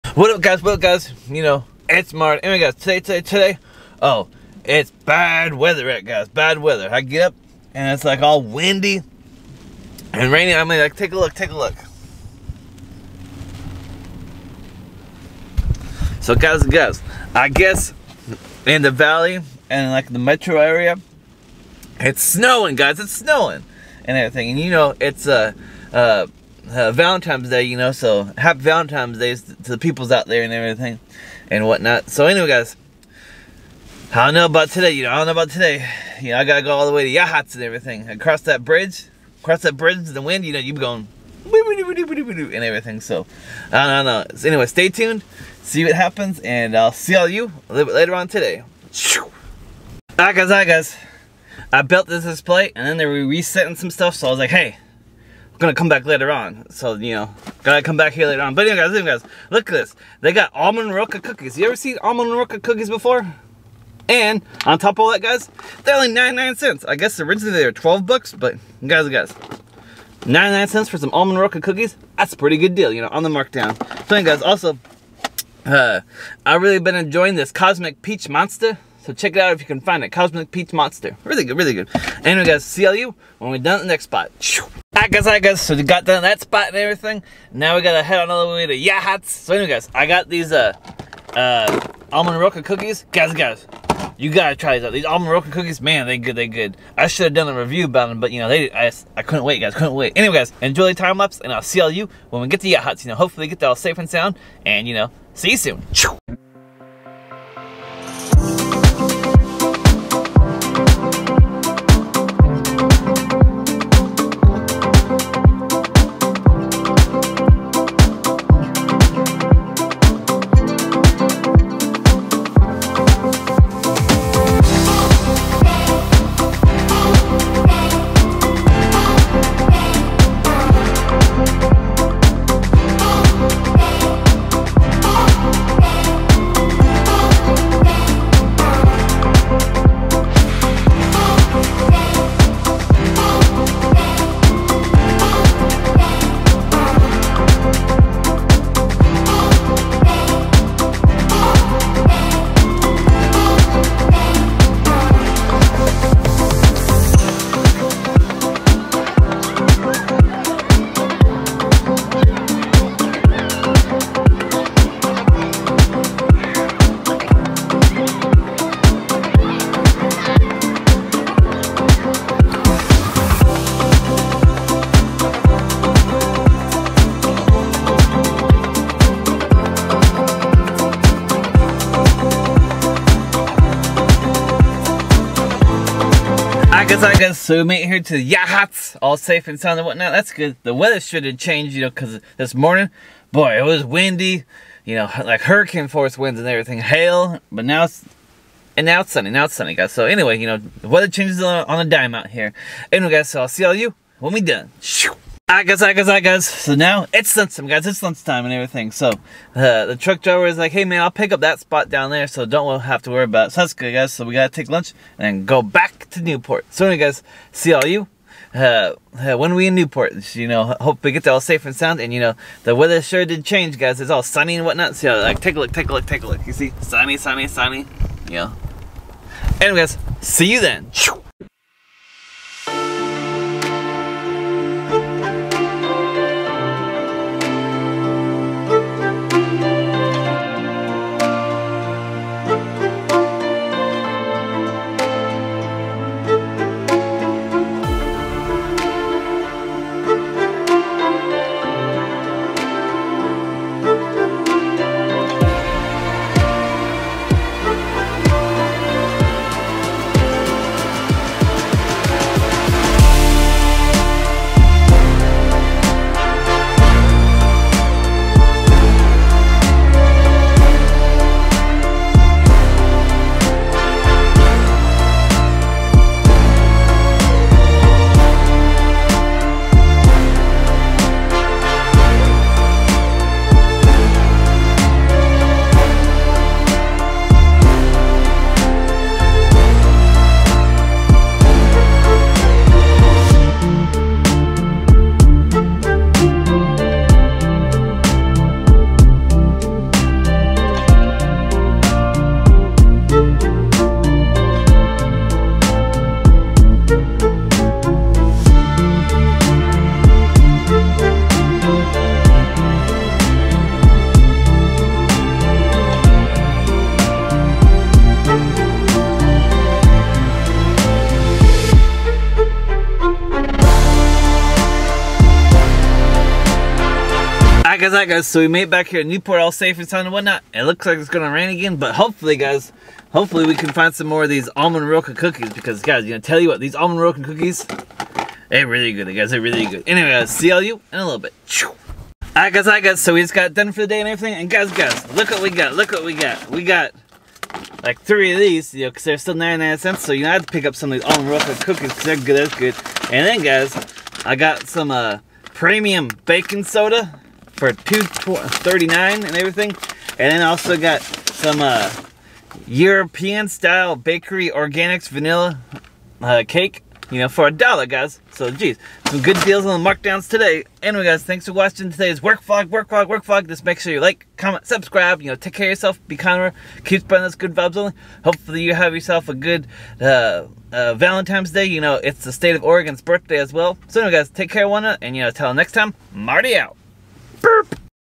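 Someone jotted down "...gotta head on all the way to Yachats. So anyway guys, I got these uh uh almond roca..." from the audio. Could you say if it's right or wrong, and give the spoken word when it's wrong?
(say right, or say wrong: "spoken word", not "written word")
right.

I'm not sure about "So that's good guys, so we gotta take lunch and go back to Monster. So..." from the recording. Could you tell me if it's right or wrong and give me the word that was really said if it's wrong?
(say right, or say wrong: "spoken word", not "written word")
wrong: "Newport", not "Monster".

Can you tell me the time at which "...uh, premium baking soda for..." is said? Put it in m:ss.
5:54.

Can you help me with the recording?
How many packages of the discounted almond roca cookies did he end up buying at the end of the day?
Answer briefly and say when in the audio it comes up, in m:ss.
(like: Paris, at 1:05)
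3, at 5:48.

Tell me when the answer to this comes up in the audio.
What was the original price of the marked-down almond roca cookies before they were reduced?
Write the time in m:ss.
1:07.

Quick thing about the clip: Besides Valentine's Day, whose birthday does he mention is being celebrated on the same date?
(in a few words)
Oregon.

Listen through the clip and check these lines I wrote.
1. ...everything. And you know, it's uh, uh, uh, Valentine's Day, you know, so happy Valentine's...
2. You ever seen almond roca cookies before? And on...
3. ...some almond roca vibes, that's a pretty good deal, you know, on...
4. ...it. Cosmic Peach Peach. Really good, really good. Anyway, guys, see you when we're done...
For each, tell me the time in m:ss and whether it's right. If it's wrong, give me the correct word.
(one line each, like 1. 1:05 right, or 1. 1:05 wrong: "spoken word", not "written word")
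1. 0:24 right
2. 1:01 right
3. 1:10 wrong: "cookies", not "vibes"
4. 1:20 wrong: "Monster", not "Peach".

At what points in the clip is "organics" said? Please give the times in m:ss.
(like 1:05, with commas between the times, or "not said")
6:04.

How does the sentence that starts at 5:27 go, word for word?
Zaka guys, So we made back here in Newport all safe and sound and whatnot.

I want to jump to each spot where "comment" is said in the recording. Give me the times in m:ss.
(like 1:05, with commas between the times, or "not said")
6:14.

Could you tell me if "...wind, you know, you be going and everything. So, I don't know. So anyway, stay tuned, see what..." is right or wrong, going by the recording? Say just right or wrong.
right.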